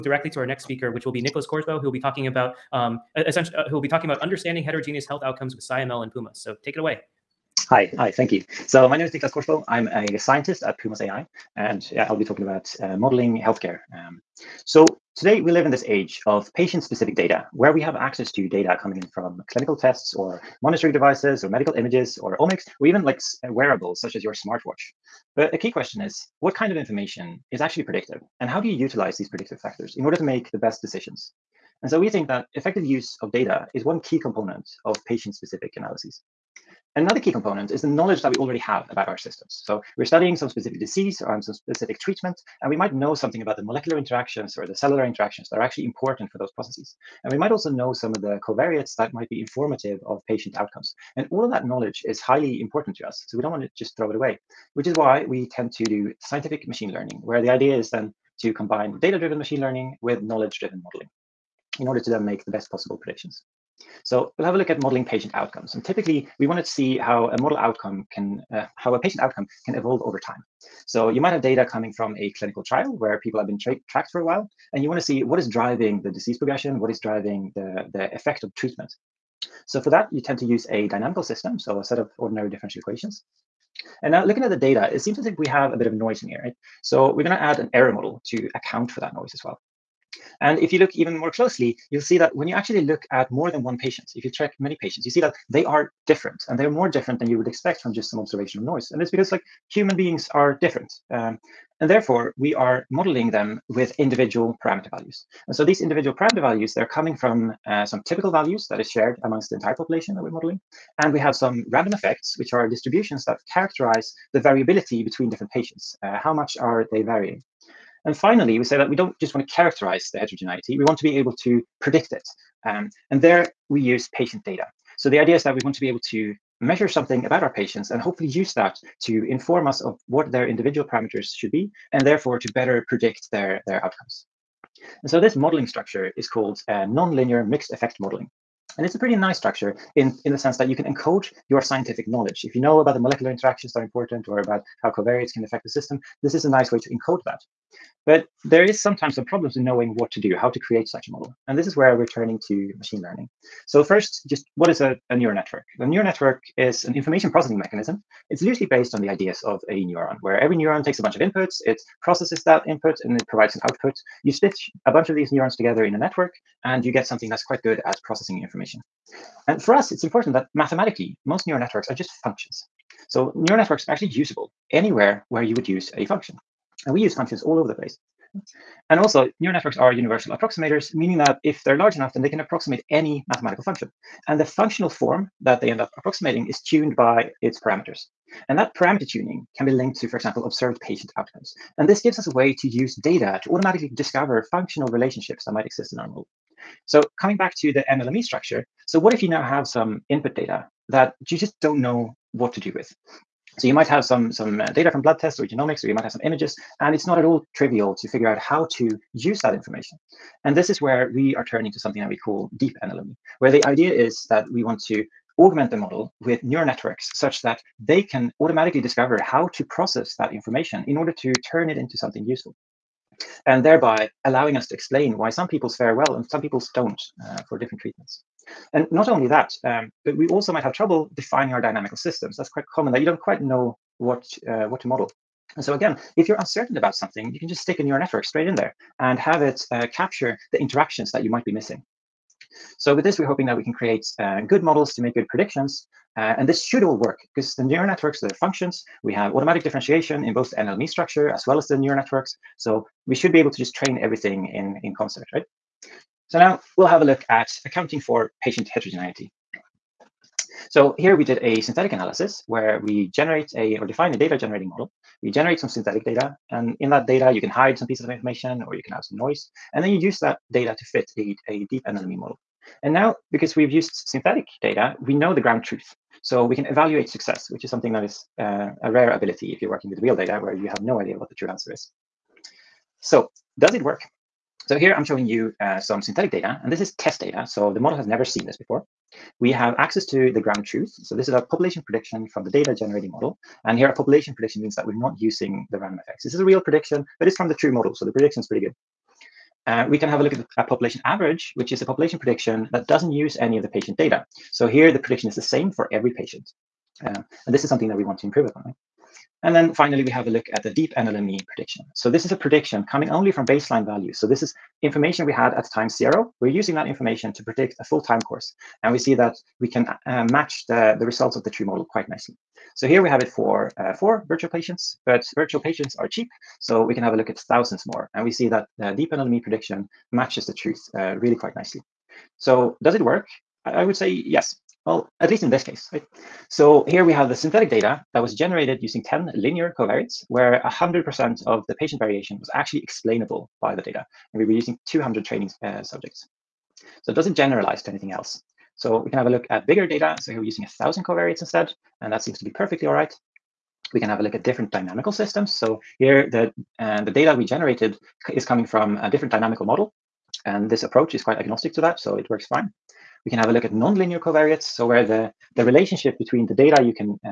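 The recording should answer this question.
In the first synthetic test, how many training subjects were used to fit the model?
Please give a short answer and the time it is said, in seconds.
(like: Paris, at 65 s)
200, at 344 s.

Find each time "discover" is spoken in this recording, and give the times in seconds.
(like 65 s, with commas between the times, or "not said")
193 s, 218 s.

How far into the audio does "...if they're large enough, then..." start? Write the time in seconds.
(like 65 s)
181 s.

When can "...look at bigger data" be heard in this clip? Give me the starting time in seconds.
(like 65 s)
349 s.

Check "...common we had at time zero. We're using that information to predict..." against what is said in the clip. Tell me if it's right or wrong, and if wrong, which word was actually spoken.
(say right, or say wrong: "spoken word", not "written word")
wrong: "information", not "common".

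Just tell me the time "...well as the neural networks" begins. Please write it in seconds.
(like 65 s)
251 s.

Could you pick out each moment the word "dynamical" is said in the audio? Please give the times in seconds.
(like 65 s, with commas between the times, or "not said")
80 s, 231 s, 354 s, 359 s.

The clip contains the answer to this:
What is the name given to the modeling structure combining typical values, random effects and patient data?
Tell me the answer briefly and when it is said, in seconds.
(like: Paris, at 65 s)
nonlinear mixed effect modeling, at 136 s.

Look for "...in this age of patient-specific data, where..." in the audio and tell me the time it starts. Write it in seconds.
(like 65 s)
15 s.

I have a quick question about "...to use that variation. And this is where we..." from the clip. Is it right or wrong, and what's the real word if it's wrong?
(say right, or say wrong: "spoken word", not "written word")
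wrong: "information", not "variation".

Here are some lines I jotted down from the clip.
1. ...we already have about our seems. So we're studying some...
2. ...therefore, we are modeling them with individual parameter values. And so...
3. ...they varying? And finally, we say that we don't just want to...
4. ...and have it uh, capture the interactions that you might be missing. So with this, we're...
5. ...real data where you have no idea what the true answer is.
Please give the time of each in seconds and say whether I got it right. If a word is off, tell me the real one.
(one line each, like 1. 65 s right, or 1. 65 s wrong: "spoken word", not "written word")
1. 38 s wrong: "systems", not "seems"
2. 101 s right
3. 116 s right
4. 238 s right
5. 280 s right.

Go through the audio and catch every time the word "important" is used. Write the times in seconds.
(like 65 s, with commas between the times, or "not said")
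45 s, 52 s, 143 s, 170 s.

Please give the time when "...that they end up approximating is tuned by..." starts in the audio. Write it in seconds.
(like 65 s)
185 s.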